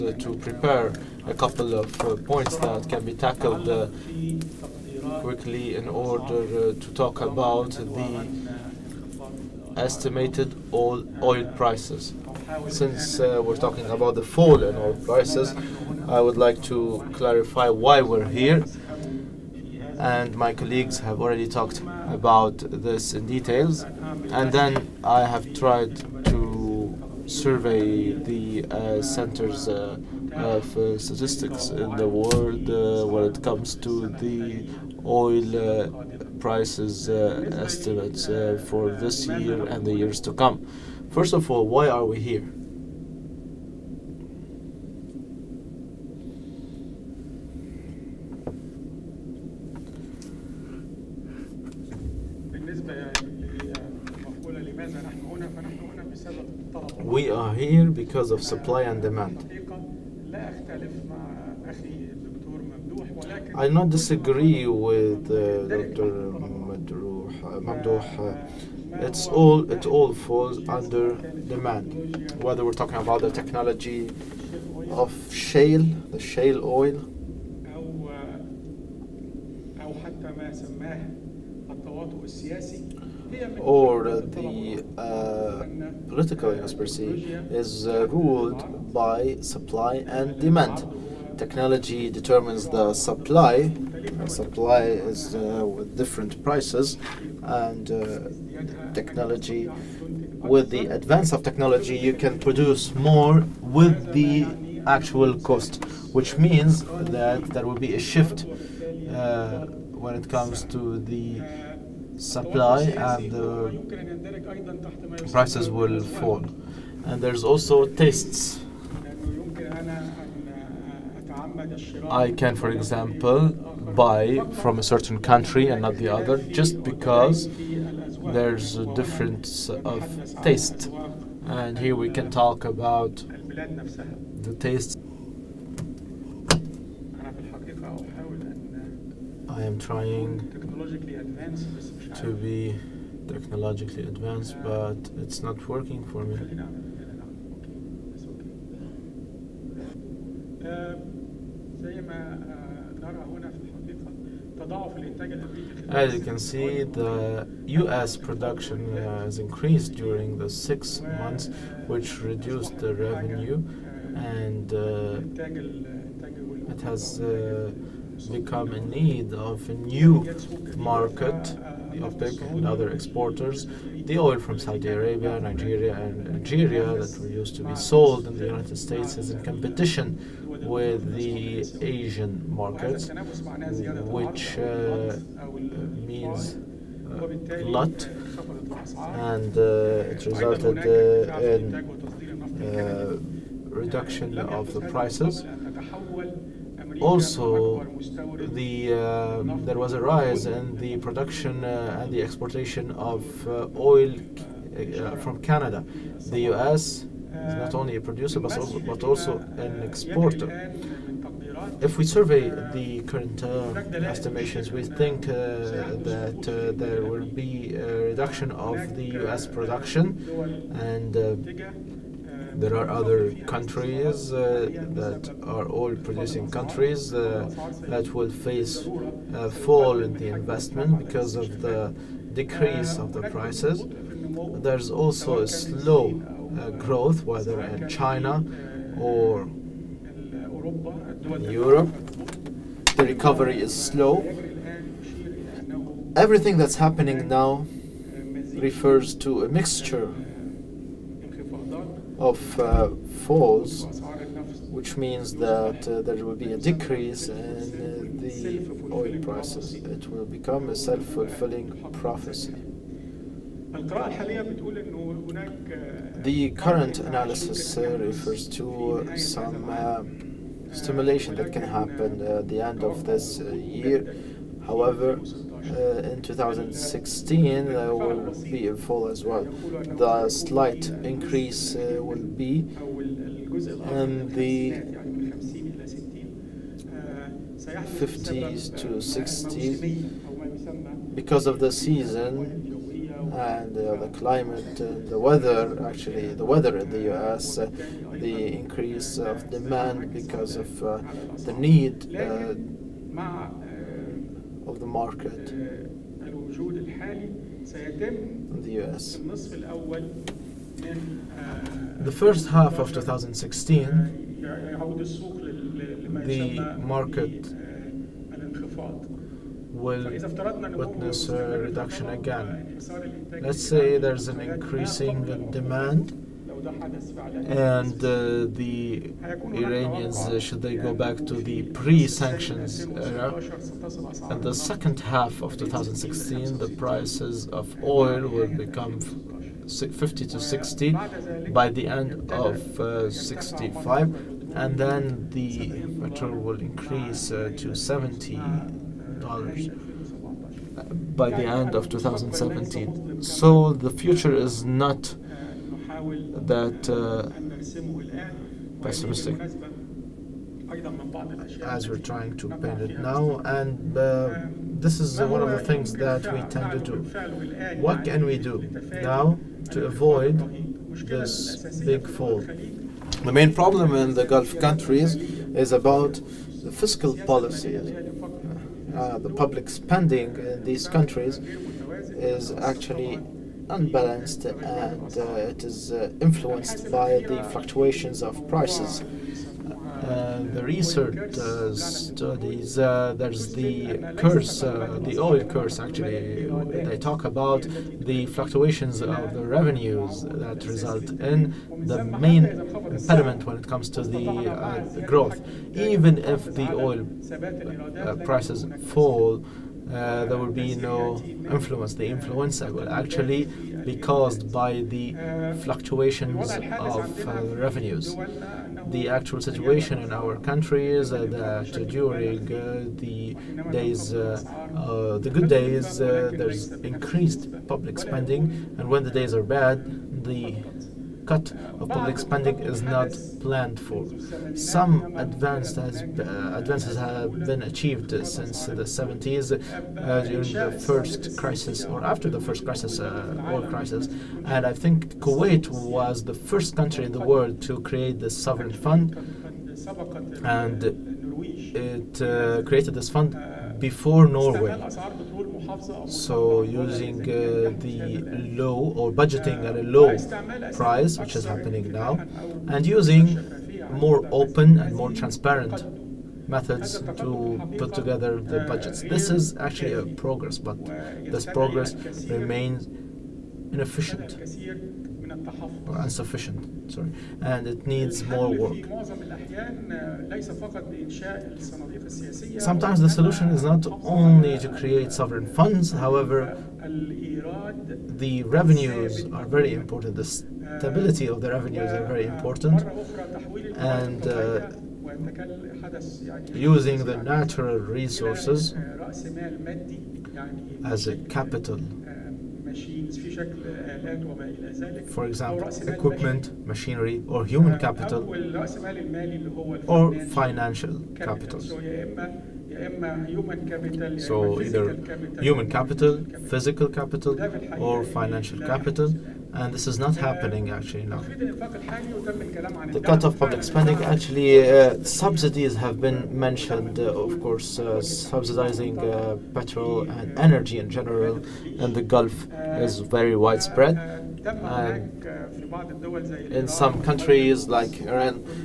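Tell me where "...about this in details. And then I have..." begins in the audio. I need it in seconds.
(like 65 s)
22 s.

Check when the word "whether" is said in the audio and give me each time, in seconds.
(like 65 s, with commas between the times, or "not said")
72 s, 237 s.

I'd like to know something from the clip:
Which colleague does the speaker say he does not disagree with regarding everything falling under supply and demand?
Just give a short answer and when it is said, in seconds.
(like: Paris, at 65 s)
Dr. Mamdouh, at 65 s.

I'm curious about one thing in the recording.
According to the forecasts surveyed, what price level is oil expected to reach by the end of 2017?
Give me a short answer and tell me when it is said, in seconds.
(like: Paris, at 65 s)
70 dollars, at 347 s.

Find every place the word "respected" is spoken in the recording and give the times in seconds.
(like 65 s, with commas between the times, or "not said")
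not said.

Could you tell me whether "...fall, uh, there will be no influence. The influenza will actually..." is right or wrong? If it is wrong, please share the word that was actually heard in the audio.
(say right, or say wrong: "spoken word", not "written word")
right.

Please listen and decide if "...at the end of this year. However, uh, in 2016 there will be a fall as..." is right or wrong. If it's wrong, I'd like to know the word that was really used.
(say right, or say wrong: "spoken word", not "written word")
right.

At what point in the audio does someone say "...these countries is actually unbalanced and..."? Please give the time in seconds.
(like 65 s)
380 s.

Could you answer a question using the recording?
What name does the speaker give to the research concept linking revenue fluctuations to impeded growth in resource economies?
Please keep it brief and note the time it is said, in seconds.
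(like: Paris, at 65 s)
the oil curse, at 395 s.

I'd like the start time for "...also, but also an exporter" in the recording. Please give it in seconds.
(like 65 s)
208 s.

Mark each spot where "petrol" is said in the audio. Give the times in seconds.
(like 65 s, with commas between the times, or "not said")
346 s, 529 s.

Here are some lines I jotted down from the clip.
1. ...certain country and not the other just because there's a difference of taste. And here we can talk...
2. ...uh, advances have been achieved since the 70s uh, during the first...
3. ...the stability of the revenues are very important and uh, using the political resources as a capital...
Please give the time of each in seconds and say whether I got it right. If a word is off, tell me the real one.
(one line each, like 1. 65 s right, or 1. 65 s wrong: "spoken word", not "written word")
1. 124 s right
2. 435 s right
3. 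490 s wrong: "natural", not "political".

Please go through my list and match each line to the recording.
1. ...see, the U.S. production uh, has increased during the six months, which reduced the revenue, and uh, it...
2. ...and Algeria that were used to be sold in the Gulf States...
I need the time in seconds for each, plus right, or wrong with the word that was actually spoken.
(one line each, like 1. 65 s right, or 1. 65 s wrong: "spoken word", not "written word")
1. 156 s right
2. 175 s wrong: "United", not "Gulf".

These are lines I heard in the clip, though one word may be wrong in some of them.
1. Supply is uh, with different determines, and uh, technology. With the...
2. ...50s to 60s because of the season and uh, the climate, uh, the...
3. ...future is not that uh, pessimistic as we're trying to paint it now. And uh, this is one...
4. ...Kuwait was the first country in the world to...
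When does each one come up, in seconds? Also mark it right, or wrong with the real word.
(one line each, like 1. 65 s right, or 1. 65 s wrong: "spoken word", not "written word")
1. 94 s wrong: "prices", not "determines"
2. 287 s right
3. 353 s right
4. 445 s right.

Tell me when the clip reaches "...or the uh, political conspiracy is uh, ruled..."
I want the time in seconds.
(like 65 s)
83 s.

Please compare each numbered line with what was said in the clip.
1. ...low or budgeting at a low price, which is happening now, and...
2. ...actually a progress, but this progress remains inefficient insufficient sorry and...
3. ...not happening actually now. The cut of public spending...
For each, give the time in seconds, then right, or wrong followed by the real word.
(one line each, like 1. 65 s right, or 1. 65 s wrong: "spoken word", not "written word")
1. 458 s right
2. 469 s right
3. 519 s right.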